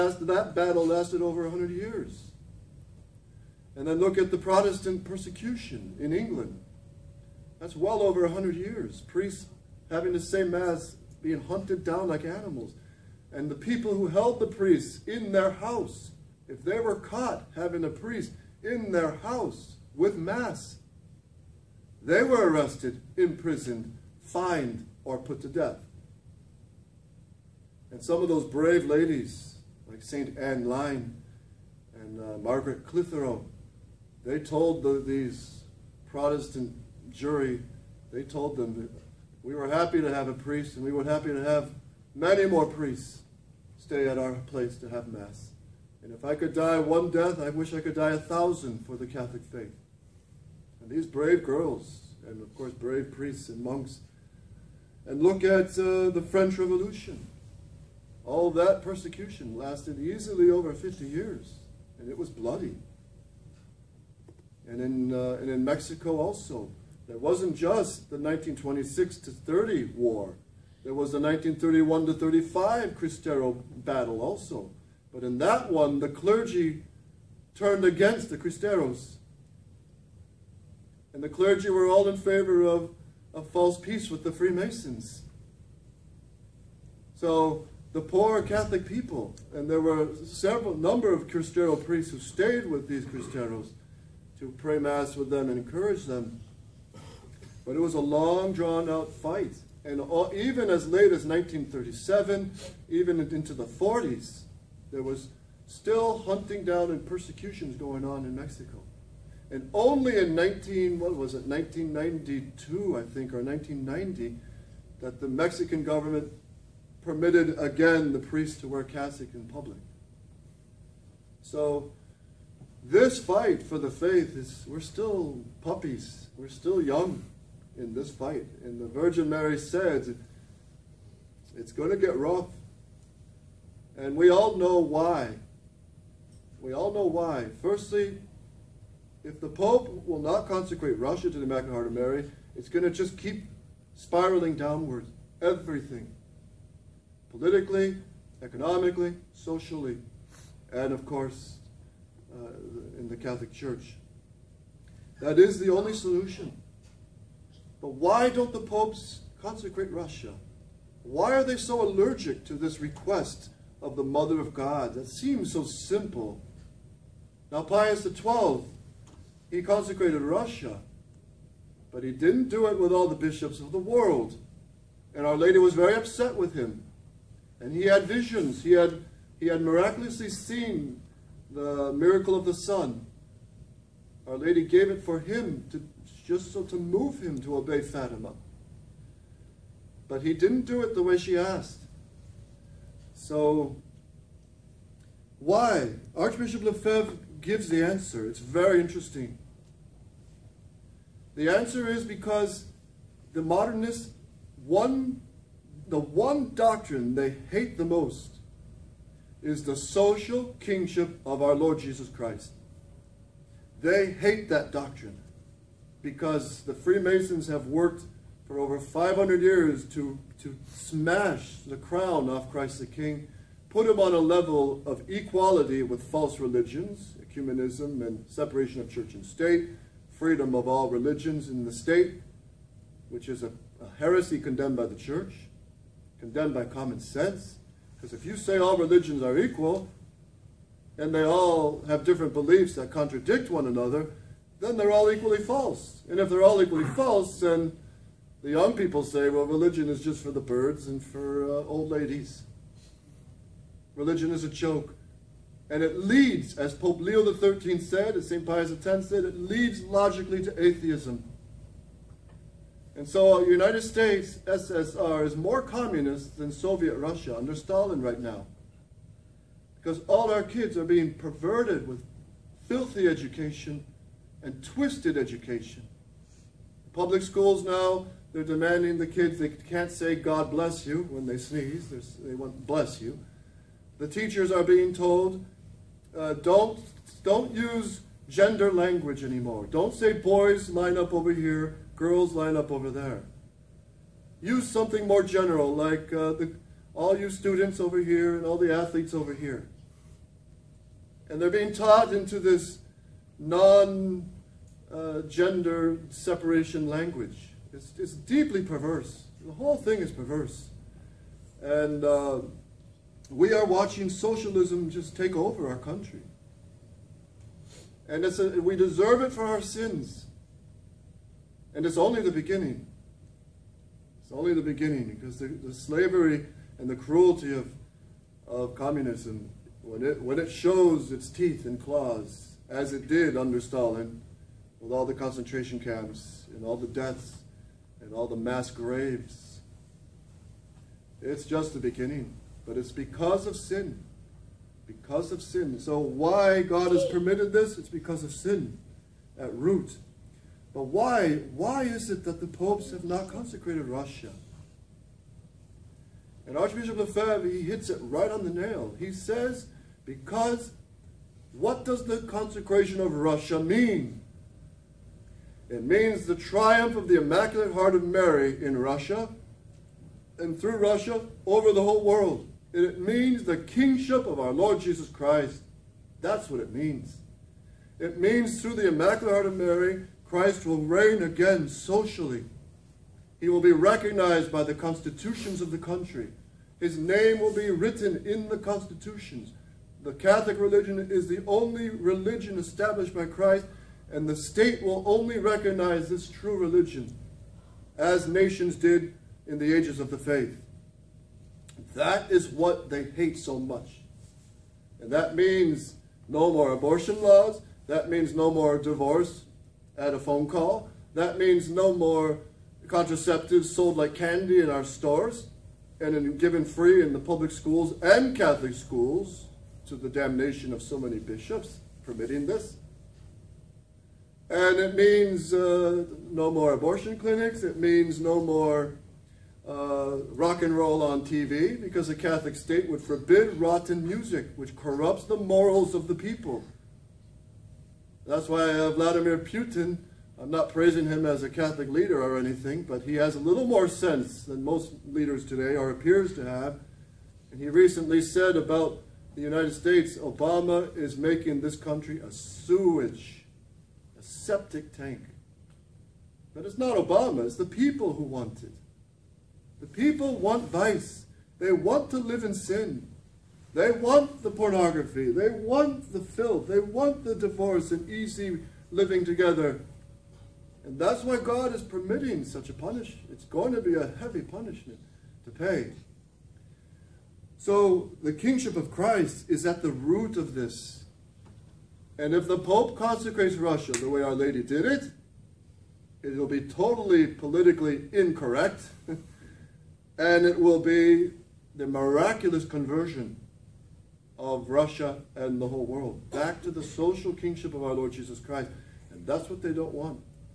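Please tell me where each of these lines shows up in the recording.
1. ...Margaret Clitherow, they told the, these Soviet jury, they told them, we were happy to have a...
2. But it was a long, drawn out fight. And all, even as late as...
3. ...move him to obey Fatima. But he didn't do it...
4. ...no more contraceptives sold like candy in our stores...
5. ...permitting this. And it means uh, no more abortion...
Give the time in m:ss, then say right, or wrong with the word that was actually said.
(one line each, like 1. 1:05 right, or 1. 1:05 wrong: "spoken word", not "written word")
1. 0:32 wrong: "Protestant", not "Soviet"
2. 1:37 right
3. 3:06 right
4. 6:51 right
5. 7:02 right.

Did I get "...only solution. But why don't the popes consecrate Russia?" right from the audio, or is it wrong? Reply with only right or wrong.
right.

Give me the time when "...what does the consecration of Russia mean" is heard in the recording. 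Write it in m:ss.
6:01.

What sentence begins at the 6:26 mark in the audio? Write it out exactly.
His name will be written in the constitutions.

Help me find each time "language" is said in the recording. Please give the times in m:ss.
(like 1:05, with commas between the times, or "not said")
4:48, 5:06.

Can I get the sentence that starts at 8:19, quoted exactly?
And that's what they don't want.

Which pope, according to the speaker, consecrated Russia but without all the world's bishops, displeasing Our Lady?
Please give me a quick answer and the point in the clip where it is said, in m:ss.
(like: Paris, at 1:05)
Pius XII, at 2:47.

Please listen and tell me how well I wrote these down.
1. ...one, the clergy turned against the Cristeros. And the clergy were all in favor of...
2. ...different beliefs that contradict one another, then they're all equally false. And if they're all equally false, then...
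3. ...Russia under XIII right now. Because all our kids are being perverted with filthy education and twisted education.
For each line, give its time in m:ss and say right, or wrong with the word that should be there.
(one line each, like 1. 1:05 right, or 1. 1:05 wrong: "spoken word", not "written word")
1. 1:15 right
2. 4:02 right
3. 4:26 wrong: "Stalin", not "XIII".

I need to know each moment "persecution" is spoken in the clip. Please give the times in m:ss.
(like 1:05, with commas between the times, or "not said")
0:05, 0:58, 1:47.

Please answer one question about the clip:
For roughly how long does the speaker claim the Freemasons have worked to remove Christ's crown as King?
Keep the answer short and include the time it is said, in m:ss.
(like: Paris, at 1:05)
over 500 years, at 3:38.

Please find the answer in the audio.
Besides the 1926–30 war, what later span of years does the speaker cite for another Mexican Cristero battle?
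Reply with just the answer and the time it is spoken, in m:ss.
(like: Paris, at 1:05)
1931 to 1935, at 1:11.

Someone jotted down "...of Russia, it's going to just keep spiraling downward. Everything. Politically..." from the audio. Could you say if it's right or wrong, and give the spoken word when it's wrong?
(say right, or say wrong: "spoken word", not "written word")
wrong: "Mary", not "Russia".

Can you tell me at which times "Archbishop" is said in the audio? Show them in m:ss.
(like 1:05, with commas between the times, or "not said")
3:16, 5:56.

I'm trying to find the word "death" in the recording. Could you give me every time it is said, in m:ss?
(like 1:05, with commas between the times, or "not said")
0:25, 0:47, 5:36.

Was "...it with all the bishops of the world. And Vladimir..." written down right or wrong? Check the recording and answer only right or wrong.
wrong.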